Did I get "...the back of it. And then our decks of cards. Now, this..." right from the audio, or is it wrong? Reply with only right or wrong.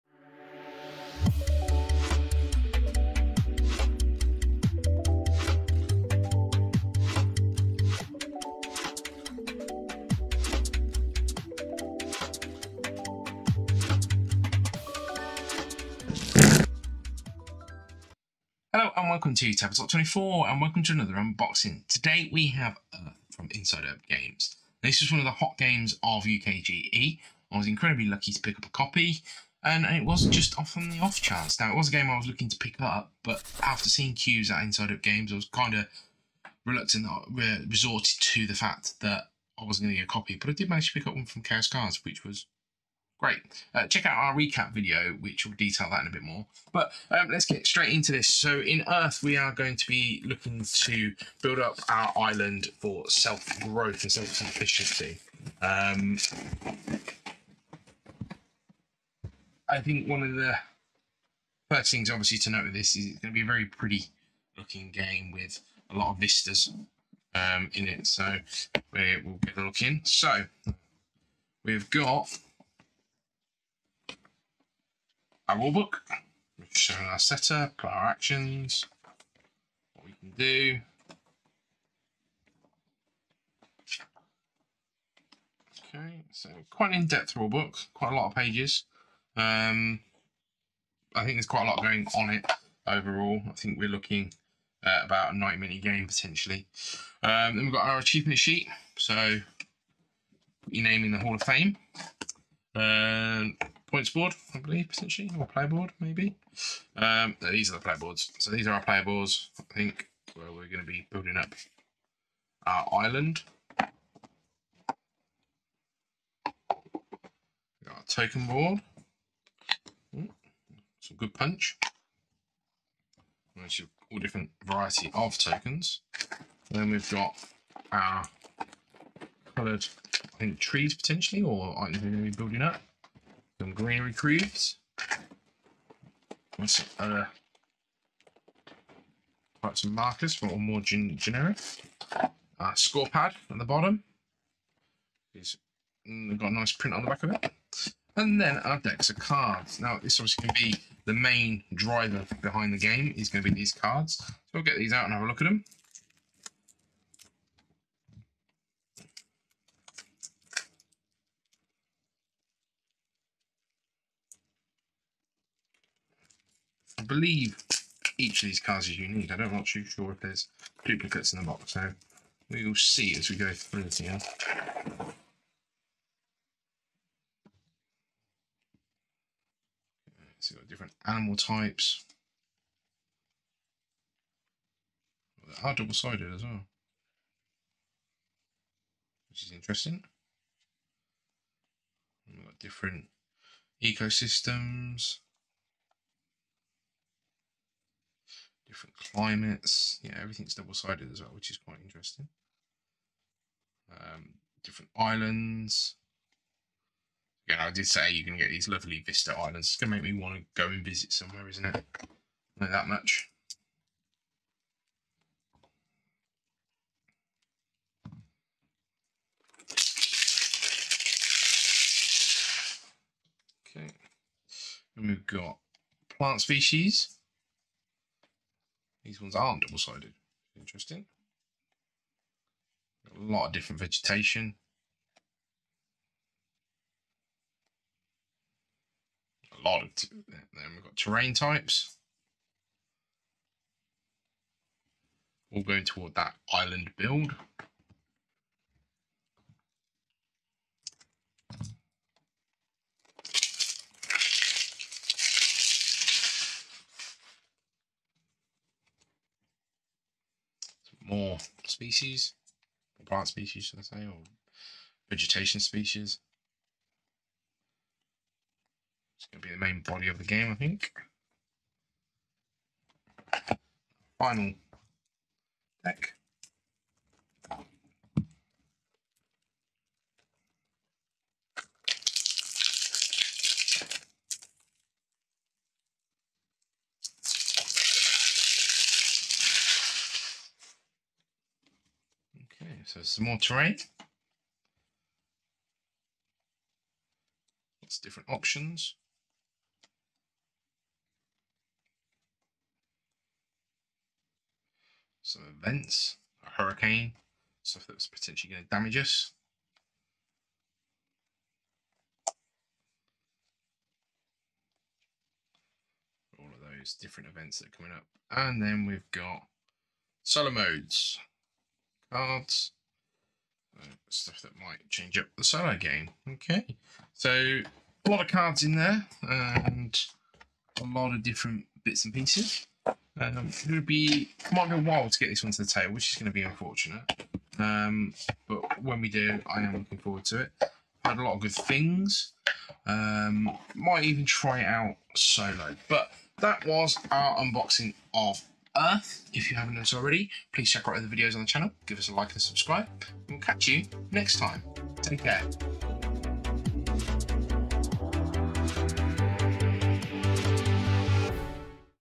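right.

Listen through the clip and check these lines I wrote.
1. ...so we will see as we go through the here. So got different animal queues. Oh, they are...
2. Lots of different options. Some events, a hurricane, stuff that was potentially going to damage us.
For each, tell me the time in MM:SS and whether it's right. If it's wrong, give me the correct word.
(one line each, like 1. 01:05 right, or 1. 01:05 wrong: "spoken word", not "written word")
1. 02:51 wrong: "types", not "queues"
2. 04:57 right.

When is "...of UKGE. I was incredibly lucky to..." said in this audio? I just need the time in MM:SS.
00:26.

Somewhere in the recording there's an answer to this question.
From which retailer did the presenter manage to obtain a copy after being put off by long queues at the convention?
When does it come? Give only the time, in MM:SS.
00:41.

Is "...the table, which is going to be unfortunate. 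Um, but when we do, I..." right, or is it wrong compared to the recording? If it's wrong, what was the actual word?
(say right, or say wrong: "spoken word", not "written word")
right.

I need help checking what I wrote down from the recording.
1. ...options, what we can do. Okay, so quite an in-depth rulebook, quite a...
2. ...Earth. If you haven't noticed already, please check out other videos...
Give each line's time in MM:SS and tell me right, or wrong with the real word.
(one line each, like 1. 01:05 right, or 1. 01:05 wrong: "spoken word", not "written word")
1. 01:18 wrong: "actions", not "options"
2. 05:48 right.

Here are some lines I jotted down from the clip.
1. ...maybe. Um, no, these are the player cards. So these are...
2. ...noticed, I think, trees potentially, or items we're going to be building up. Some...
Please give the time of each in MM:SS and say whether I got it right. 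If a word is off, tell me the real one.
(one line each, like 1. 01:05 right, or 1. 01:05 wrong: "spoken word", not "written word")
1. 01:45 wrong: "boards", not "cards"
2. 02:09 wrong: "coloured", not "noticed".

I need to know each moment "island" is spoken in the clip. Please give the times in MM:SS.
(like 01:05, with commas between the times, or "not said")
00:52, 01:53, 03:24, 03:29, 04:06.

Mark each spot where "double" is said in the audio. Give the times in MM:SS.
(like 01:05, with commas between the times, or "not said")
03:05, 03:20, 03:49.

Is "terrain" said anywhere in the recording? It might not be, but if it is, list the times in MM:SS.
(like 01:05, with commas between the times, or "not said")
04:00, 04:53.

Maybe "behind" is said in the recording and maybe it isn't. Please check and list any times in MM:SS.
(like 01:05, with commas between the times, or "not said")
02:32.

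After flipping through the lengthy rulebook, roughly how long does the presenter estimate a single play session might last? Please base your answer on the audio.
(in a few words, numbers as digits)
90 minutes.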